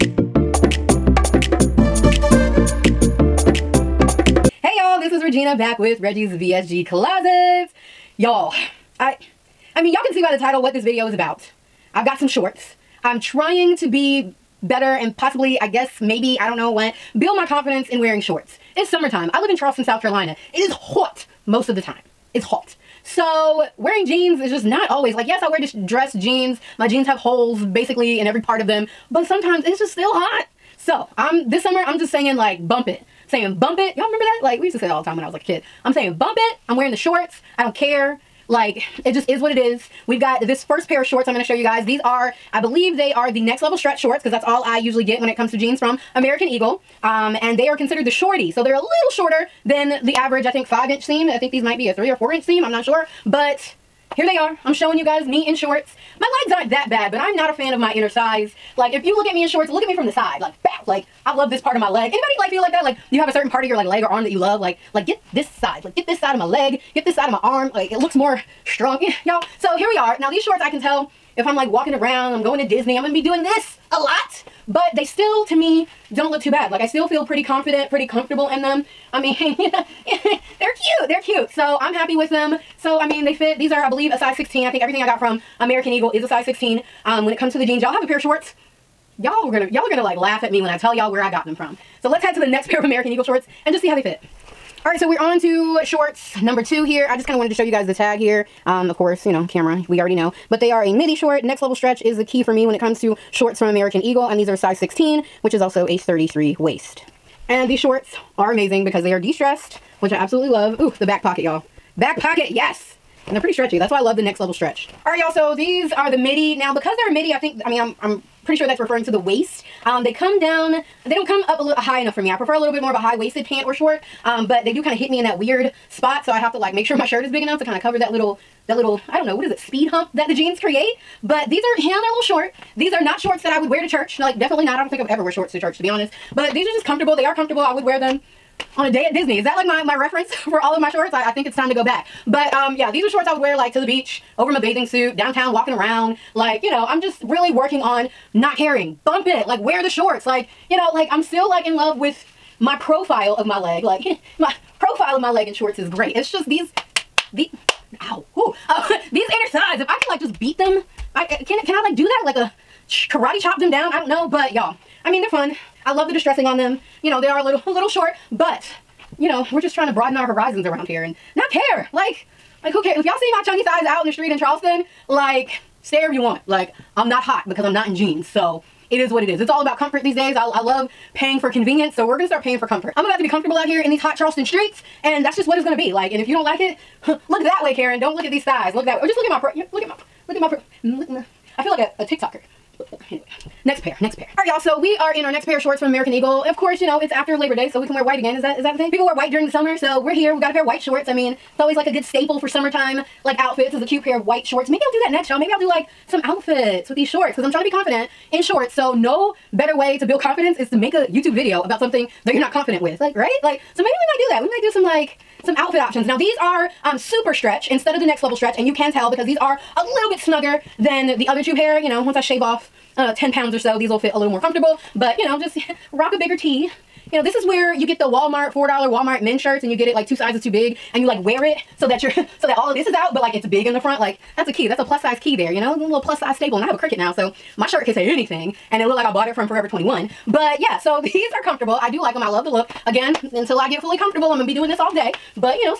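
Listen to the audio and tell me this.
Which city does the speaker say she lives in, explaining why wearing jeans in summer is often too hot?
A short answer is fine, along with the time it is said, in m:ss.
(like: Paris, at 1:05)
Charleston, South Carolina, at 0:19.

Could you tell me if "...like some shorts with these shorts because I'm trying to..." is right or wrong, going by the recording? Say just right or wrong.
wrong.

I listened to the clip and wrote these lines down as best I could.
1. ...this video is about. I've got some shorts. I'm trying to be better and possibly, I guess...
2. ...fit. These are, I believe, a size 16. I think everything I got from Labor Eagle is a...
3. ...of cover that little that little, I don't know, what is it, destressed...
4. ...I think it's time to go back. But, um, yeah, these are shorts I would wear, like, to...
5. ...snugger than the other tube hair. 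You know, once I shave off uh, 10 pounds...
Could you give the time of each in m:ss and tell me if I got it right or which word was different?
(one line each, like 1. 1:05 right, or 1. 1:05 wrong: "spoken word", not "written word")
1. 0:10 right
2. 1:23 wrong: "American", not "Labor"
3. 2:07 wrong: "speed", not "destressed"
4. 2:21 right
5. 3:40 right.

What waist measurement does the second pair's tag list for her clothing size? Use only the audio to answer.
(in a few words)
33.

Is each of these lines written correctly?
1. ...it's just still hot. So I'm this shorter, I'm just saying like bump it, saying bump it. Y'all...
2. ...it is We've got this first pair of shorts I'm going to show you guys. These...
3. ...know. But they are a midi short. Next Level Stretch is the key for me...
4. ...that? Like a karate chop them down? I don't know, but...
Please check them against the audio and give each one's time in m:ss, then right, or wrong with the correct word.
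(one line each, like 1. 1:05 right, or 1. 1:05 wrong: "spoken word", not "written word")
1. 0:29 wrong: "summer", not "shorter"
2. 0:39 right
3. 1:40 right
4. 2:42 right.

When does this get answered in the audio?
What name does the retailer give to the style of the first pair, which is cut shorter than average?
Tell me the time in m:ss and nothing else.
0:48.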